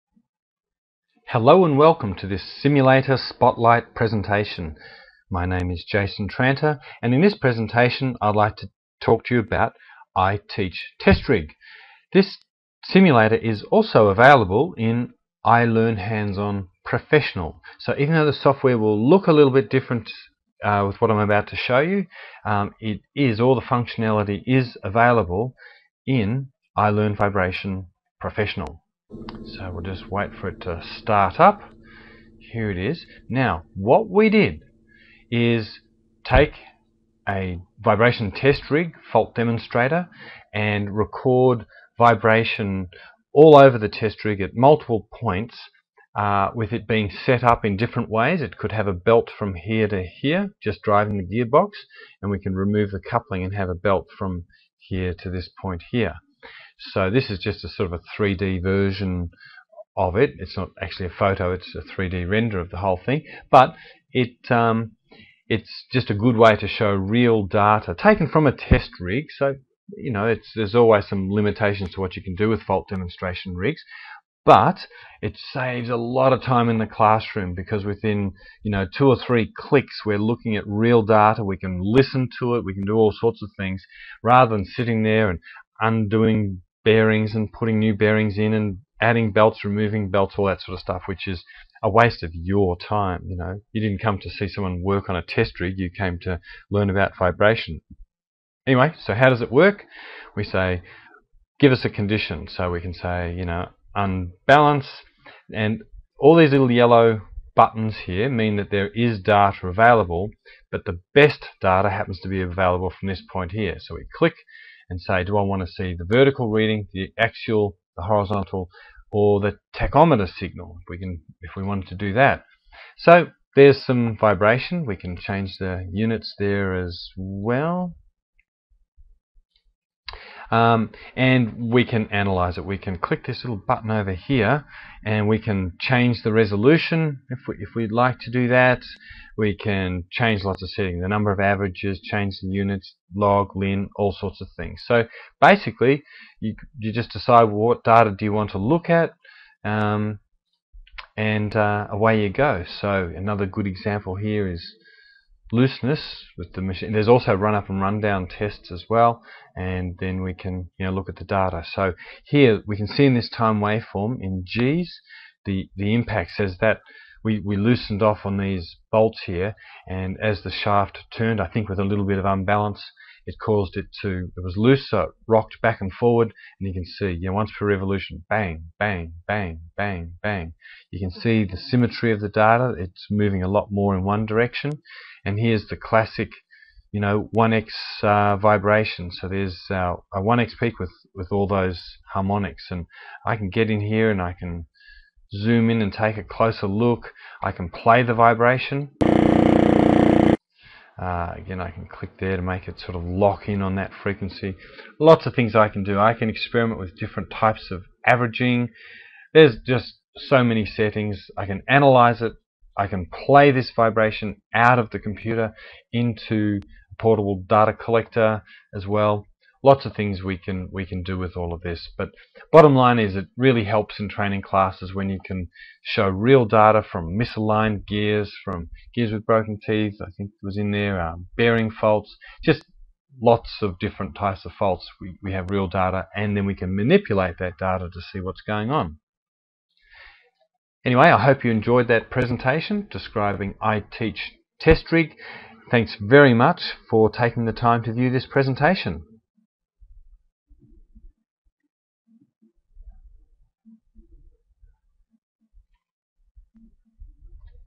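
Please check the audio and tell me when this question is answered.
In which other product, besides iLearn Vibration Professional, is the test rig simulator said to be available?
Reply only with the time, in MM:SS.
00:15.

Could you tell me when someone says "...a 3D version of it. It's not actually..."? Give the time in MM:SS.
00:57.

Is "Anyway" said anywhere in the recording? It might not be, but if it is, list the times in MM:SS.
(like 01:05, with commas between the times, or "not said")
01:38, 04:00.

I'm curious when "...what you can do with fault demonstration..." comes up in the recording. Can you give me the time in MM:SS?
01:12.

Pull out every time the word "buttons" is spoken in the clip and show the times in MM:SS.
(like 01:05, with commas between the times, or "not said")
01:47, 02:13.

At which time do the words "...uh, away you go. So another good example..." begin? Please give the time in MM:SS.
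02:31.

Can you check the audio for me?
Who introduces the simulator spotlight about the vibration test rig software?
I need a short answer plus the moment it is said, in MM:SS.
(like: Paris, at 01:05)
Jason Tranter, at 00:05.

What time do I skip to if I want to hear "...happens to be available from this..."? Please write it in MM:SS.
01:51.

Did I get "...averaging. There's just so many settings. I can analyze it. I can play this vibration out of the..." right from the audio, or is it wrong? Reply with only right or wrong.
right.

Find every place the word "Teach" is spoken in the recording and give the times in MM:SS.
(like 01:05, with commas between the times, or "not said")
00:10, 04:03.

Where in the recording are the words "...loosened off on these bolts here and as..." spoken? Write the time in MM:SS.
02:47.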